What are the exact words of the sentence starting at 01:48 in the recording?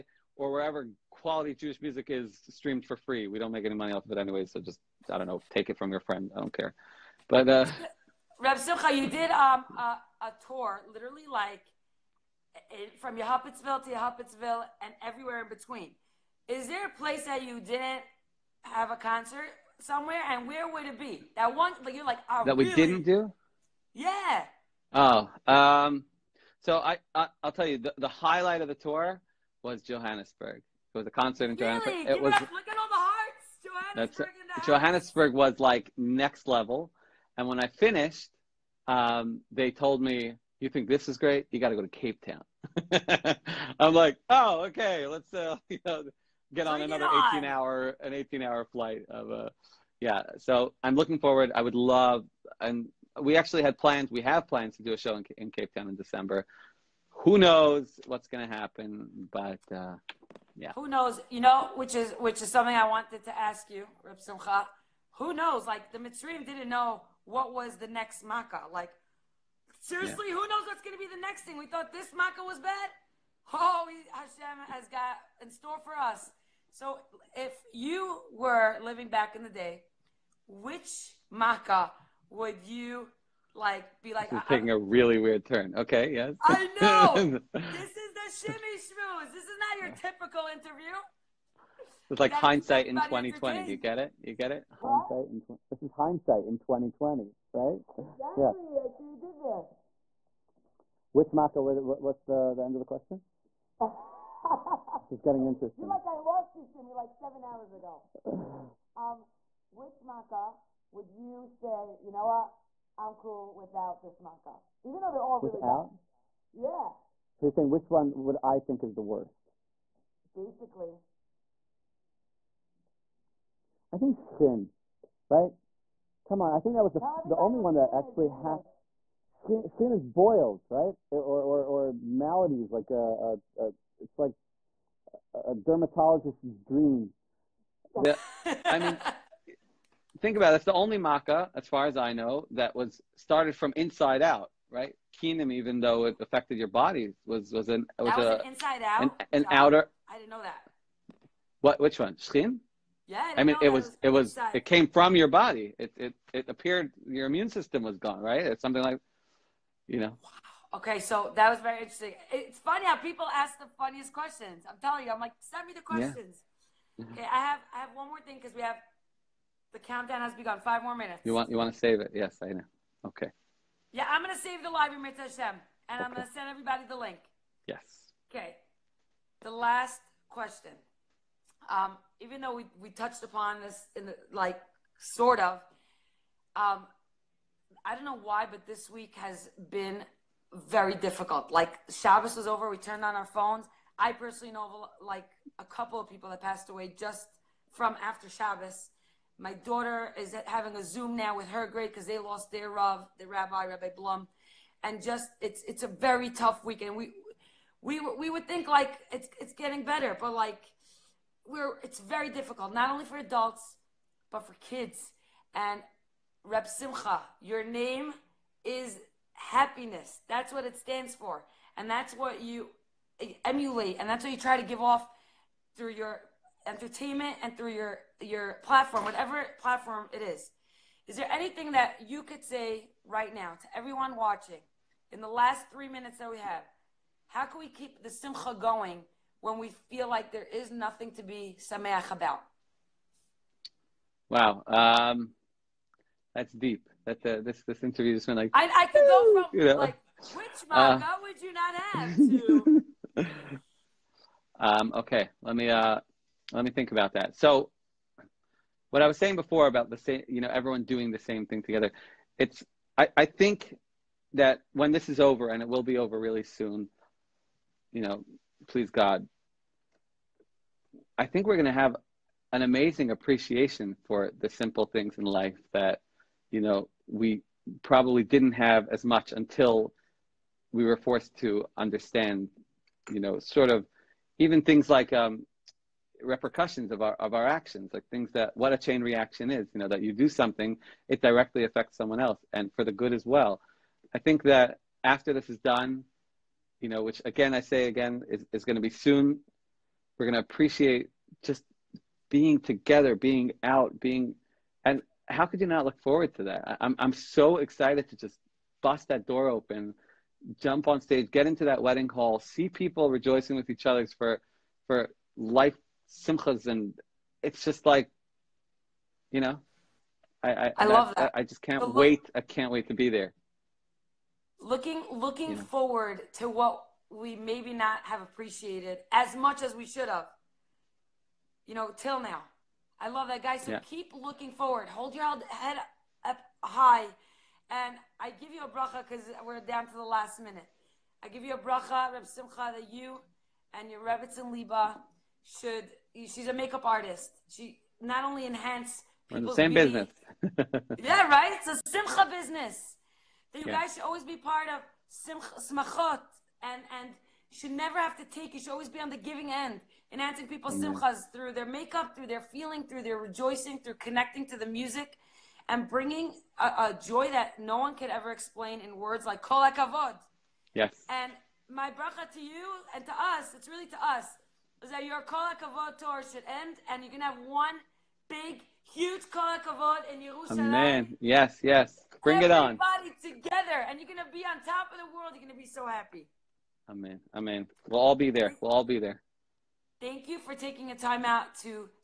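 um, which maka would you say, you know what, I'm cool without this maka.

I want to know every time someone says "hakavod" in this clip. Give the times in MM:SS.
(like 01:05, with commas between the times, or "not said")
06:09, 06:15, 06:19.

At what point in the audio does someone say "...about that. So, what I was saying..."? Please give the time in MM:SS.
04:16.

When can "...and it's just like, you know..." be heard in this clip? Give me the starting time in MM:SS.
05:16.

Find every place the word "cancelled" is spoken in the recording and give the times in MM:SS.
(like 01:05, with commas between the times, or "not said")
not said.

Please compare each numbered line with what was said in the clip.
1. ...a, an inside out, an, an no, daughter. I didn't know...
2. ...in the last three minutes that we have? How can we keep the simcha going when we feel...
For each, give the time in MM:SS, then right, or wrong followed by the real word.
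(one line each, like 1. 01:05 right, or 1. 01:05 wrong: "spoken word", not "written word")
1. 02:28 wrong: "outer", not "daughter"
2. 03:55 right.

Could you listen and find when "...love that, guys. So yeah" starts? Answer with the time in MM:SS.
05:33.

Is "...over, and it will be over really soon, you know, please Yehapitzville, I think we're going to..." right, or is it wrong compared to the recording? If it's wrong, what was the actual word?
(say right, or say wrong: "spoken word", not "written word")
wrong: "God", not "Yehapitzville".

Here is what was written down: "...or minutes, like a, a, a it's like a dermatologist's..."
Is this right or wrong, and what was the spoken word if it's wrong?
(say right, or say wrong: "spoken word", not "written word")
wrong: "maladies", not "minutes".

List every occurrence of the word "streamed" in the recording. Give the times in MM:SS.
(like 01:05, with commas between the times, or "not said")
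00:02.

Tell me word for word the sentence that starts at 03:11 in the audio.
Like Shabbos was over, we turned on our phones.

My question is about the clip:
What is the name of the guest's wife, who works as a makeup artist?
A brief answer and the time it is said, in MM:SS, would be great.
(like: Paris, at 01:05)
Liba, at 05:44.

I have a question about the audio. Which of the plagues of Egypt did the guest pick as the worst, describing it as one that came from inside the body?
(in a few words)
Shchin.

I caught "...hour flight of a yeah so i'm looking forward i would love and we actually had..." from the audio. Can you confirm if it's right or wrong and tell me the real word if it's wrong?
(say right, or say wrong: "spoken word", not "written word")
right.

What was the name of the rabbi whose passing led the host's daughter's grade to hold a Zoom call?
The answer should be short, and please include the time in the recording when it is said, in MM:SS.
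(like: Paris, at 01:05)
Rabbi Blum, at 03:23.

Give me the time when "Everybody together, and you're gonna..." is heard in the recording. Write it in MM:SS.
06:23.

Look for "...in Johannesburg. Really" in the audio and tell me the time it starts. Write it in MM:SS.
00:31.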